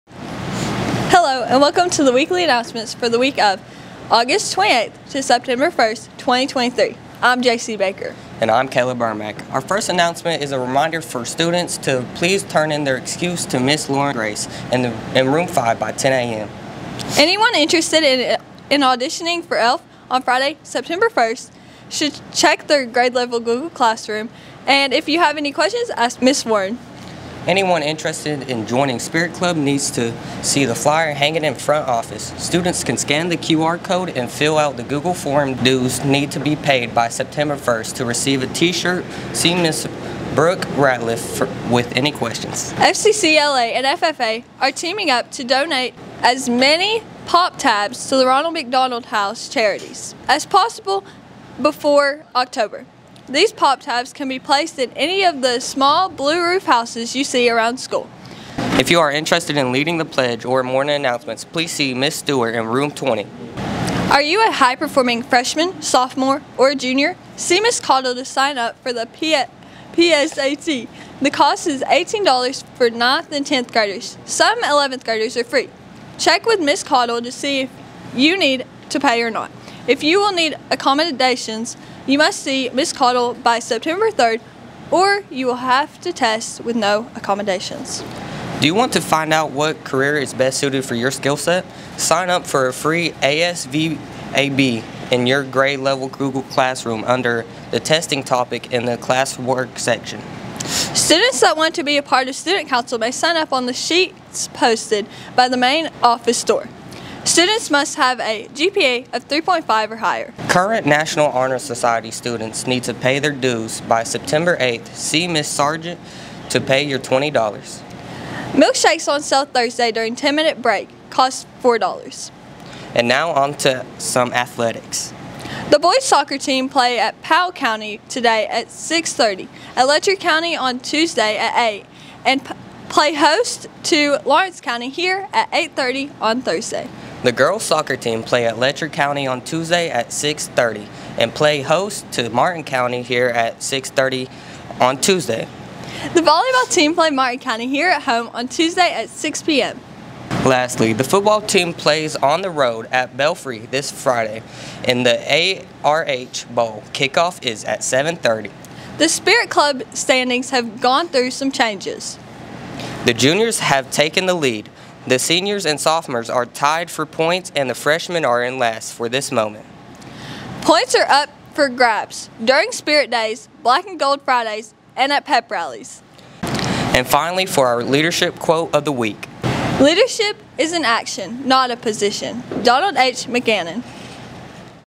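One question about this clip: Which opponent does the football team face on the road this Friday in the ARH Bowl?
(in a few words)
Belfry.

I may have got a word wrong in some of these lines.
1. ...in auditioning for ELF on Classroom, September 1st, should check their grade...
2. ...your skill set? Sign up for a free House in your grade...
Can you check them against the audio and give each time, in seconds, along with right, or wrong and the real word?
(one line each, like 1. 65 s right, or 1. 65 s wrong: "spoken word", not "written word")
1. 18 s wrong: "Friday", not "Classroom"
2. 90 s wrong: "ASVAB", not "House".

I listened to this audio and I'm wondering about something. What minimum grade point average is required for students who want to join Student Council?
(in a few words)
3.5.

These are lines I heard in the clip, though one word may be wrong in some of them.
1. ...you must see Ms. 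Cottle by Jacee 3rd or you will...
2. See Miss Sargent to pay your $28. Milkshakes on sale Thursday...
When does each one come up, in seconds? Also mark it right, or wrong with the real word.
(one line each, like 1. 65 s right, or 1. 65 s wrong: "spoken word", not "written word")
1. 82 s wrong: "September", not "Jacee"
2. 114 s wrong: "20", not "28".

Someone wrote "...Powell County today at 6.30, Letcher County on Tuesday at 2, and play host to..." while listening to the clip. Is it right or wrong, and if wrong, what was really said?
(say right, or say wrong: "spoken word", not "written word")
wrong: "8", not "2".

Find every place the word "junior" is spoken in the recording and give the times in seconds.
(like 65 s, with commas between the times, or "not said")
66 s, 163 s.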